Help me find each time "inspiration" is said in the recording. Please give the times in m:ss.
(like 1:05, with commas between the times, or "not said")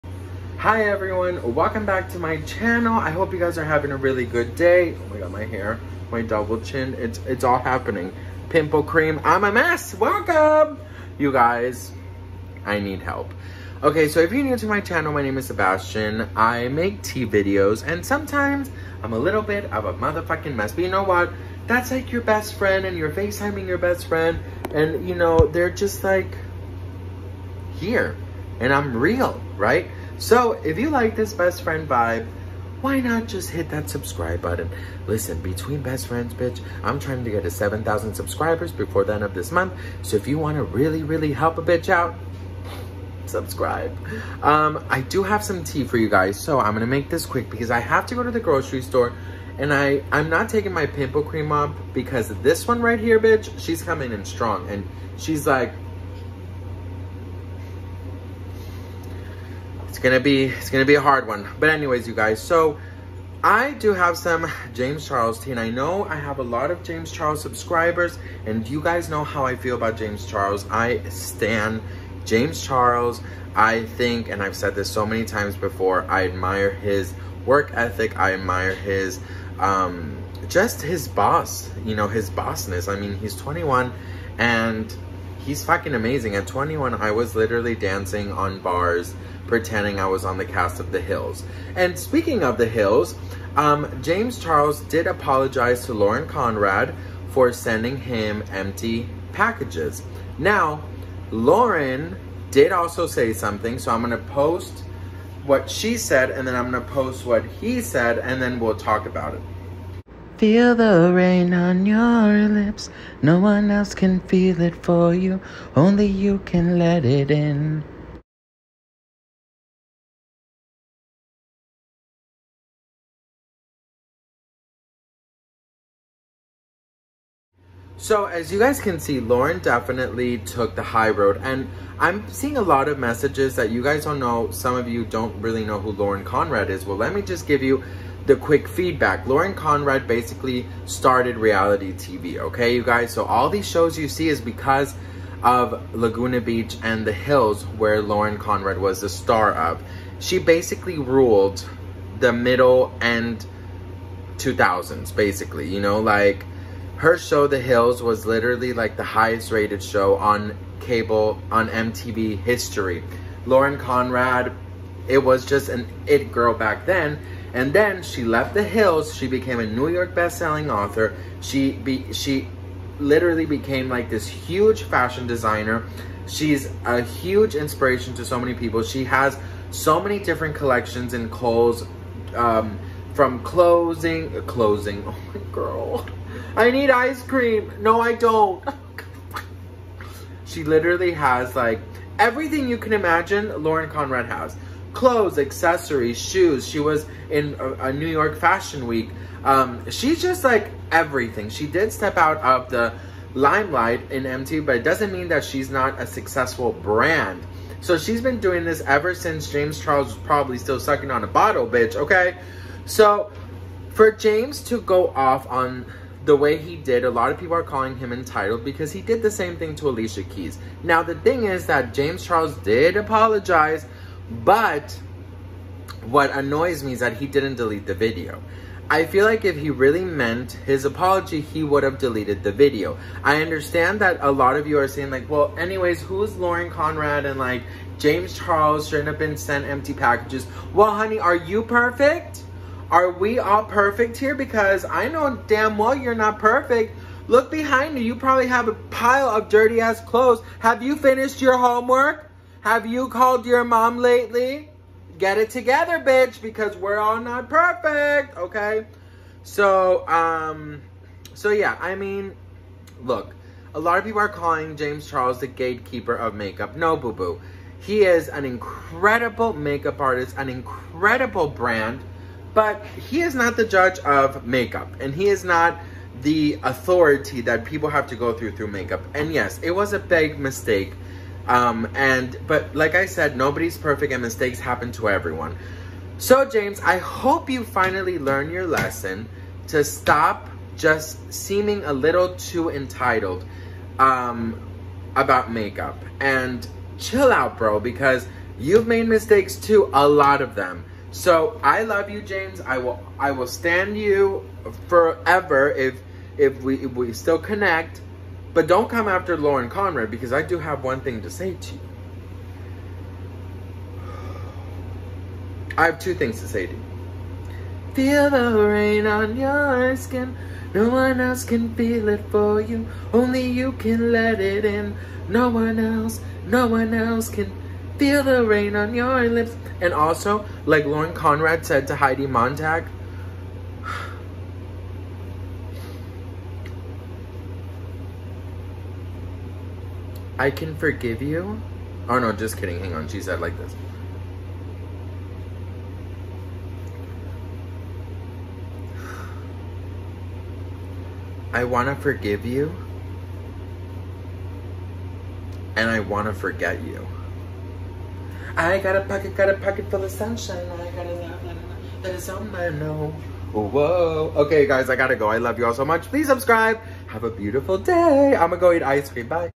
2:57.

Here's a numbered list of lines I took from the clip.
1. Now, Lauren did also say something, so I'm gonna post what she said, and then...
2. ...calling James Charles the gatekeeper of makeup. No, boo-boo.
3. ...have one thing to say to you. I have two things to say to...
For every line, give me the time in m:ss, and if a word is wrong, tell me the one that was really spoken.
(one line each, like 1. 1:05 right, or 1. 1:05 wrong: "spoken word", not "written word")
1. 1:40 right
2. 4:24 right
3. 5:10 right.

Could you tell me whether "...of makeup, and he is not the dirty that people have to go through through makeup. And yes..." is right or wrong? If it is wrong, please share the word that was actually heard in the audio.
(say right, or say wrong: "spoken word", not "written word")
wrong: "authority", not "dirty".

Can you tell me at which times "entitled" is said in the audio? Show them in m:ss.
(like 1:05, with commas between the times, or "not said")
3:38, 4:52.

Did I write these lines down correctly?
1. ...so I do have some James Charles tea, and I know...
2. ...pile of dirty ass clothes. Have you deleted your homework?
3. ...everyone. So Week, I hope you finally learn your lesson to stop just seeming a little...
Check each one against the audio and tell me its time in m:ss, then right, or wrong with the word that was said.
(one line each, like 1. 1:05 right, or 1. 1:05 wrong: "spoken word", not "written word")
1. 1:02 right
2. 4:08 wrong: "finished", not "deleted"
3. 4:45 wrong: "James", not "Week".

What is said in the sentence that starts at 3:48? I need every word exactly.
I feel like if he really meant his apology, he would have deleted the video.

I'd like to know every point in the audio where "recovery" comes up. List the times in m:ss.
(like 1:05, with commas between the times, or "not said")
not said.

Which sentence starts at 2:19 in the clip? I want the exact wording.
Lauren Conrad basically started reality TV, okay, you guys?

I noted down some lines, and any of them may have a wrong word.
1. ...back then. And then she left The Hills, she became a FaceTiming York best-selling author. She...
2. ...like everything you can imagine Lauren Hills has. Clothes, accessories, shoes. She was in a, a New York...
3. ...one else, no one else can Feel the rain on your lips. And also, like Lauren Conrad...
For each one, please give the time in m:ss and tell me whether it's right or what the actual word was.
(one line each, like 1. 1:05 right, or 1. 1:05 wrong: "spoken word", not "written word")
1. 2:46 wrong: "New", not "FaceTiming"
2. 3:11 wrong: "Conrad", not "Hills"
3. 5:25 right.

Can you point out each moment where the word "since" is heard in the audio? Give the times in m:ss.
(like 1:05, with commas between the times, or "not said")
3:29.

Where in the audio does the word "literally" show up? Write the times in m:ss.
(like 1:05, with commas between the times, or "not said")
1:27, 2:38, 2:52, 3:10.